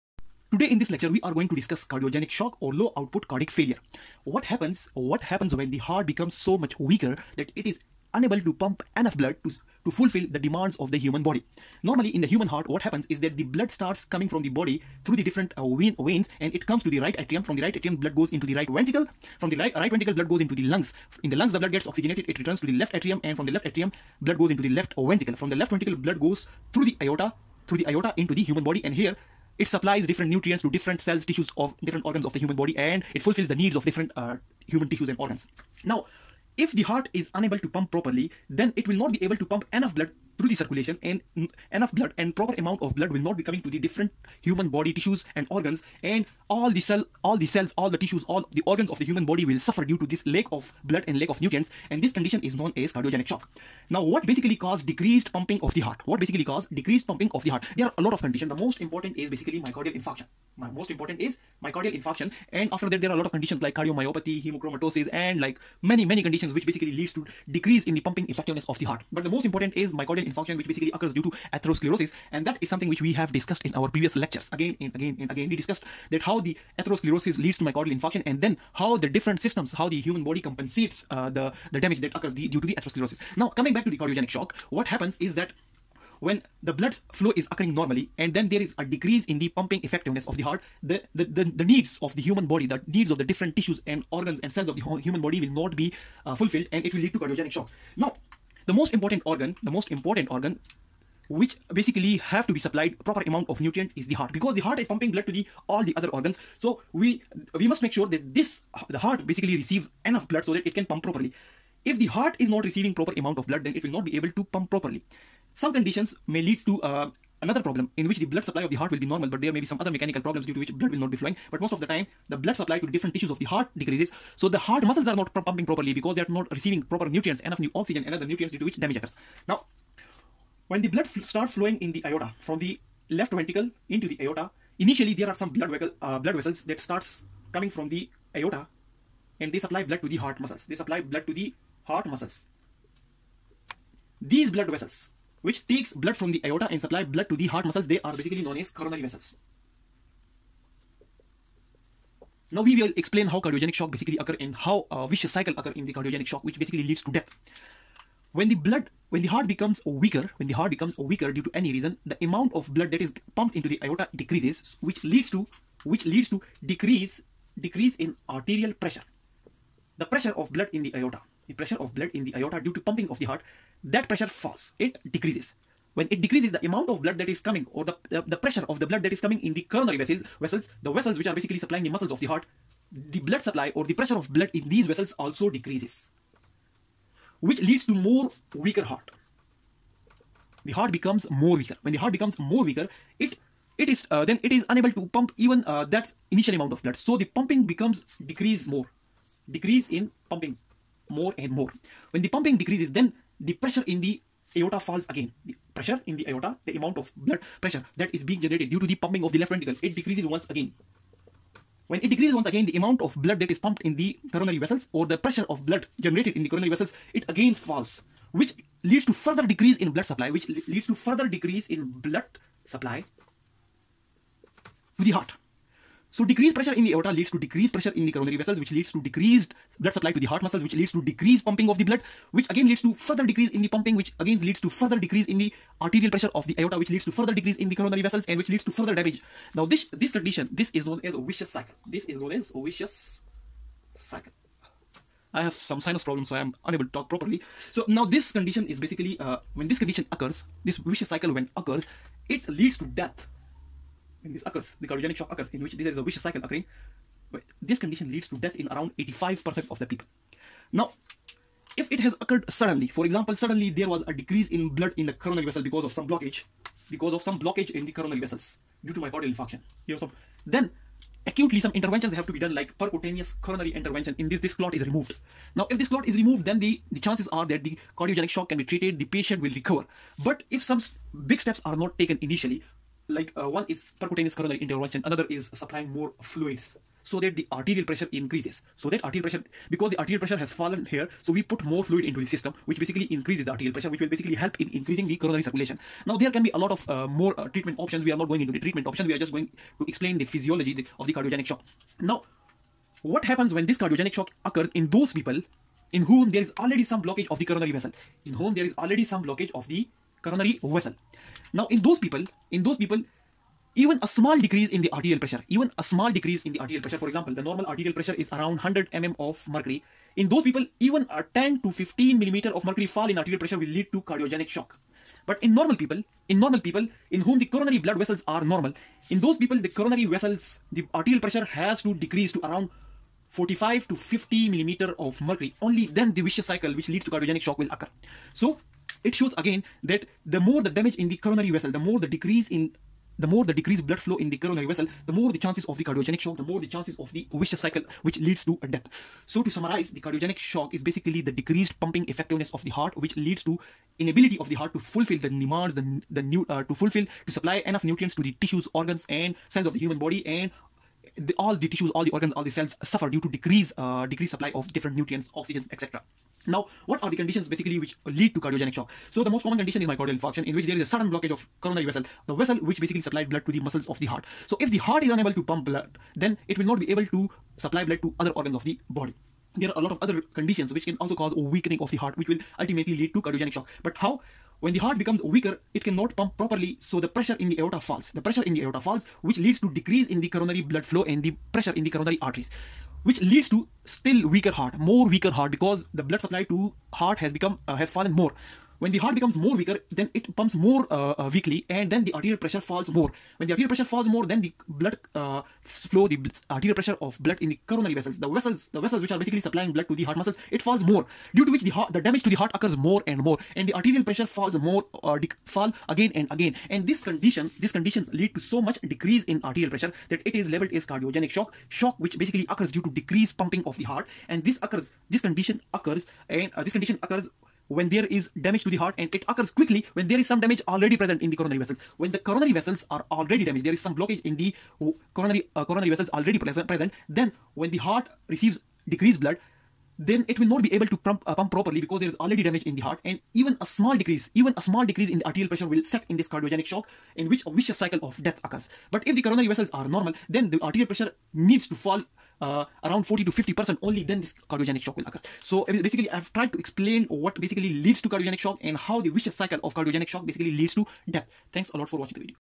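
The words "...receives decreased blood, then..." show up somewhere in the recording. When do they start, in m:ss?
7:18.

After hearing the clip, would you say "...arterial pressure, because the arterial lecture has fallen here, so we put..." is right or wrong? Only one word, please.
wrong.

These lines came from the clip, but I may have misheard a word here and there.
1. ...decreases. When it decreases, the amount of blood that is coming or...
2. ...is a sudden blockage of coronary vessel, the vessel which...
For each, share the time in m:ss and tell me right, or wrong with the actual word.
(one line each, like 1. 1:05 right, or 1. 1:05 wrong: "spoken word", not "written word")
1. 2:55 right
2. 6:10 right.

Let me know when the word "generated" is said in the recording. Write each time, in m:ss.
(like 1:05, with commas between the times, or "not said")
3:28, 3:35.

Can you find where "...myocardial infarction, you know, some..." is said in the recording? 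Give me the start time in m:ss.
4:28.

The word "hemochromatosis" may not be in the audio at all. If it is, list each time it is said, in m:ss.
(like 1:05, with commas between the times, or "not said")
1:04.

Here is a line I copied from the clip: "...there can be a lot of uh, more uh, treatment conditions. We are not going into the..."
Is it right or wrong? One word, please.
wrong.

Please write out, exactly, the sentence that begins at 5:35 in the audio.
Only then the vicious cycle which leads to cardiogenic shock will occur.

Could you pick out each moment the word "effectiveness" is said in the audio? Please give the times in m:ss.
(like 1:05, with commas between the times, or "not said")
1:08, 1:29, 5:52.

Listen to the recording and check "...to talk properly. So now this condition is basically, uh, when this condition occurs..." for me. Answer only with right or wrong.
right.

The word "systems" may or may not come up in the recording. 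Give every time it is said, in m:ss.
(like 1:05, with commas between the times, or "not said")
1:19, 4:52.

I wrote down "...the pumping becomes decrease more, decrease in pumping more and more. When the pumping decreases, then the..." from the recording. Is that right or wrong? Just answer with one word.
right.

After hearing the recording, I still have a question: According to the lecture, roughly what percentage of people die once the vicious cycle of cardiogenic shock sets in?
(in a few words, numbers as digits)
85%.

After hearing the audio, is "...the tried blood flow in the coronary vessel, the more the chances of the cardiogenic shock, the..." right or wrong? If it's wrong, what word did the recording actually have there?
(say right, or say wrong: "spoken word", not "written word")
wrong: "decreased", not "tried".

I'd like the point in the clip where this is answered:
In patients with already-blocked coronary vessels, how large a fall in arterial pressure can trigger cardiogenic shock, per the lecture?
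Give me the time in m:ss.
5:21.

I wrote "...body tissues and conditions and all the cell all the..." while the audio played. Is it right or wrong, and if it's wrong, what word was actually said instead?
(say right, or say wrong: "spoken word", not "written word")
wrong: "organs", not "conditions".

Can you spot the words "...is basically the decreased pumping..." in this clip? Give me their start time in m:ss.
5:50.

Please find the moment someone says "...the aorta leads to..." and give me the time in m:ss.
3:46.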